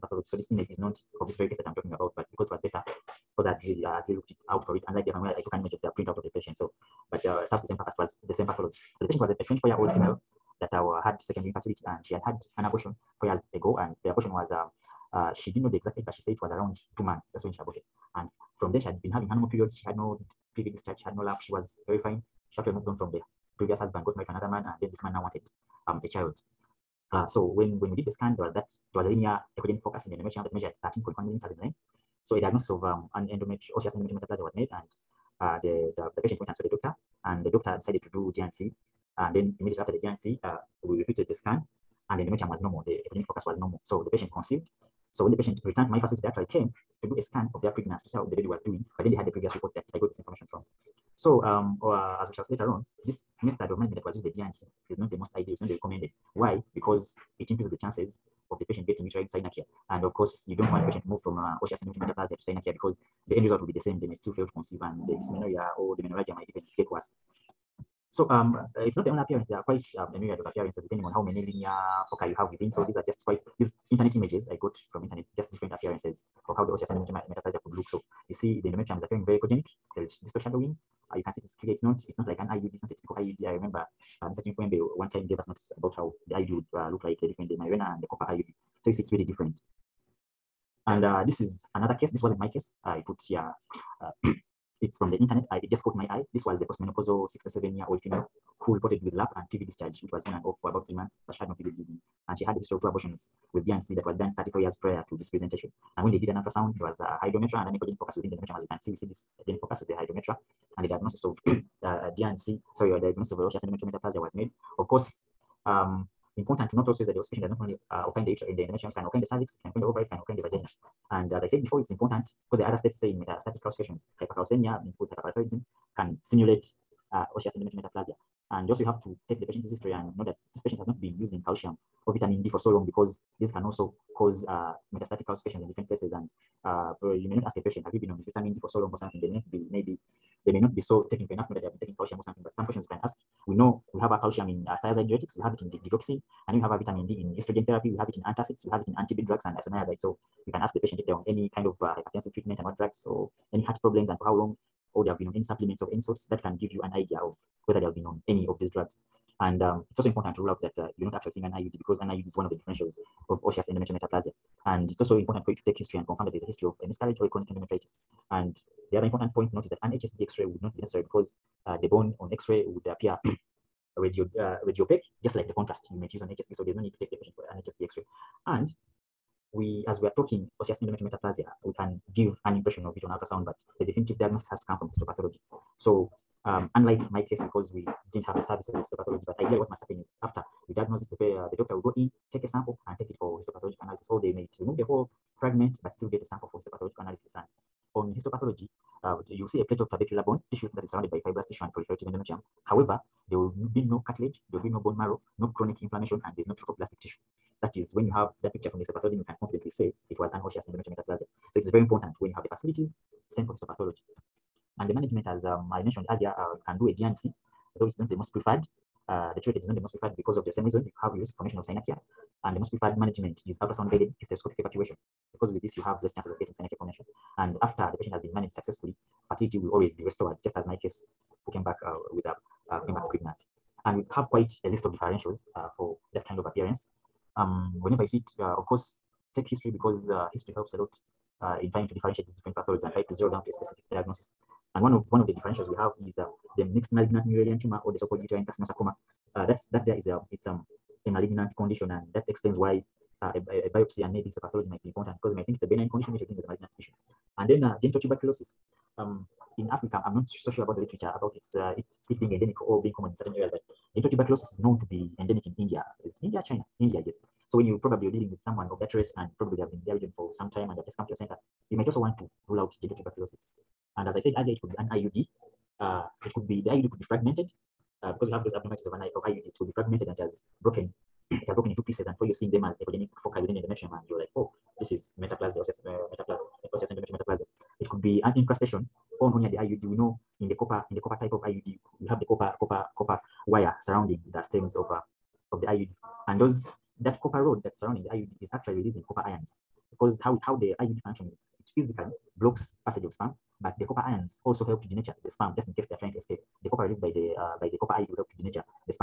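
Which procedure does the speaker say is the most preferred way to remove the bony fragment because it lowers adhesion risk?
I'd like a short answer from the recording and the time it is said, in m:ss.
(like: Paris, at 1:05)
ultrasound guided hysteroscopic evacuation, at 3:43.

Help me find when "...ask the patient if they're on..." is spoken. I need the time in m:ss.
2:30.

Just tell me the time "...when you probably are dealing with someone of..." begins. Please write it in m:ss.
4:27.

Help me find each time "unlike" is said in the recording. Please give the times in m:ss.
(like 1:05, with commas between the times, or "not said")
0:04, 3:06.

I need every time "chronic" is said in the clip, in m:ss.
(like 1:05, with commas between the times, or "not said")
2:47, 3:25.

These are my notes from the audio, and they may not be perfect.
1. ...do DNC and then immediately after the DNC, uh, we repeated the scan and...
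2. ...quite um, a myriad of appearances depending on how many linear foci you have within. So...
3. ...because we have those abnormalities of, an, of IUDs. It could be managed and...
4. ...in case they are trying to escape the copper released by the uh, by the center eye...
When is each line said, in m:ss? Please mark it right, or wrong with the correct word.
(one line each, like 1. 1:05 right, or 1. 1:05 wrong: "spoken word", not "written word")
1. 0:38 right
2. 1:09 right
3. 4:38 wrong: "fragmented", not "managed"
4. 5:05 wrong: "copper", not "center".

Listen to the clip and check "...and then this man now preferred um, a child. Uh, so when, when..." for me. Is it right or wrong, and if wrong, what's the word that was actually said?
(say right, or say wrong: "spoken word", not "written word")
wrong: "wanted", not "preferred".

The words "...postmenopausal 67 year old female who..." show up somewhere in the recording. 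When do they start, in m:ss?
1:36.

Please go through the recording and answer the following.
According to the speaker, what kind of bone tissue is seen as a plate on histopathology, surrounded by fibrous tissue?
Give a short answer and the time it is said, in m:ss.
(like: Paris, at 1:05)
trabecular bone, at 3:19.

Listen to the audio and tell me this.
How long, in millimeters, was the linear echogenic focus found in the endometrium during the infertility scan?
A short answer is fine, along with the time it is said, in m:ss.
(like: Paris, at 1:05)
13.1 millimeters, at 0:30.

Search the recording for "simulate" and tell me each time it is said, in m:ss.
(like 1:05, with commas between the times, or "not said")
2:06.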